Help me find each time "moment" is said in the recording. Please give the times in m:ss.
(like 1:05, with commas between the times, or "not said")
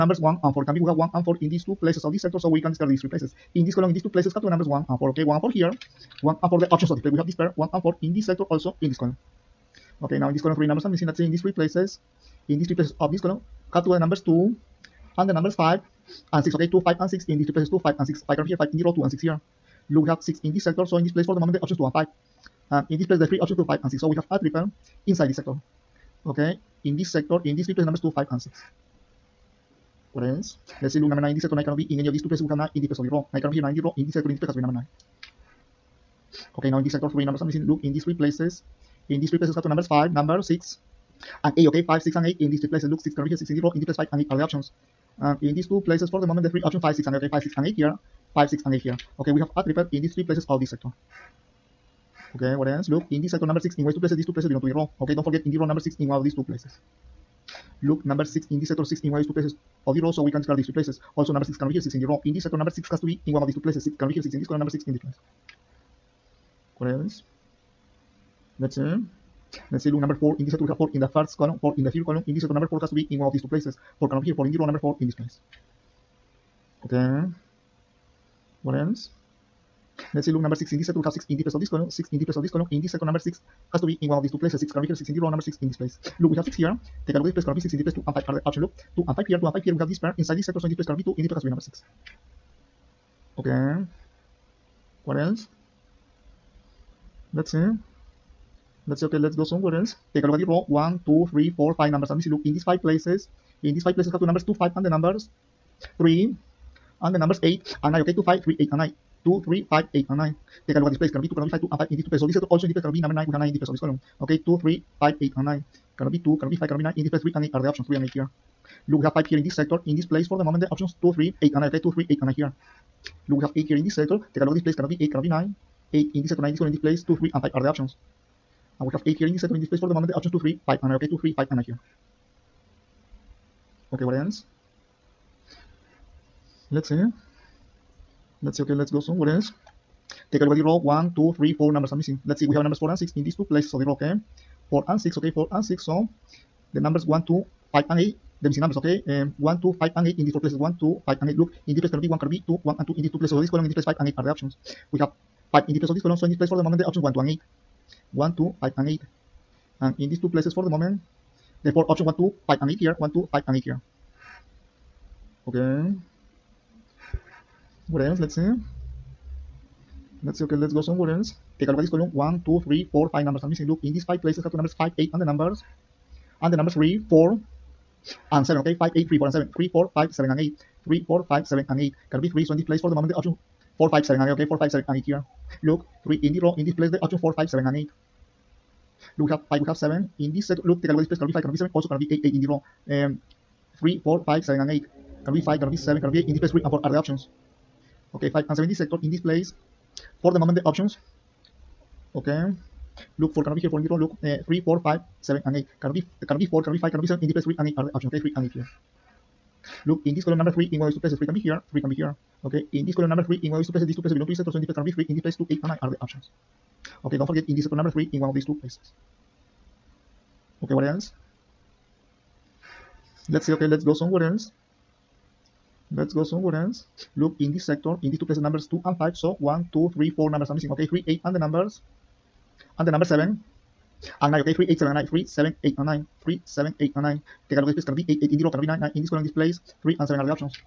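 0:21, 0:46, 2:00, 2:09, 2:36, 2:40, 3:02, 3:20.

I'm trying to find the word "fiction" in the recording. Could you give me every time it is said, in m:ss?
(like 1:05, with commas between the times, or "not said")
not said.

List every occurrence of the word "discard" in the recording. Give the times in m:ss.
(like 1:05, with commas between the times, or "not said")
0:02, 1:00.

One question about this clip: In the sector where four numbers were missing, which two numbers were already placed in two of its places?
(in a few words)
2 and 5.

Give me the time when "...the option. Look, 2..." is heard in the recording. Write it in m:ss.
1:28.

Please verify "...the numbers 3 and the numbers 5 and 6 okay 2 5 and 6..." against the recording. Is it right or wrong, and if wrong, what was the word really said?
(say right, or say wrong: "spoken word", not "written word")
wrong: "2", not "3".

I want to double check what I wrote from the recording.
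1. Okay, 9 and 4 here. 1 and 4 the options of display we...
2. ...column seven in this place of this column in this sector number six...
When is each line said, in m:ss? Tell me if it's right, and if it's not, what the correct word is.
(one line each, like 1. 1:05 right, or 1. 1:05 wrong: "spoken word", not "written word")
1. 0:05 wrong: "1", not "9"
2. 1:21 wrong: "six", not "seven".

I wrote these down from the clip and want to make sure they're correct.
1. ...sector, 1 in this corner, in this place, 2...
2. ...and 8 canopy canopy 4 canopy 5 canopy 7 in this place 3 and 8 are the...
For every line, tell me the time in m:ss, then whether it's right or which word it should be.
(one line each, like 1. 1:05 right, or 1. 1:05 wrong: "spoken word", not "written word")
1. 2:06 wrong: "9", not "1"
2. 3:25 right.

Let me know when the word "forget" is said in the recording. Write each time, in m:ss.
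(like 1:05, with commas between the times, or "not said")
0:55, 3:37.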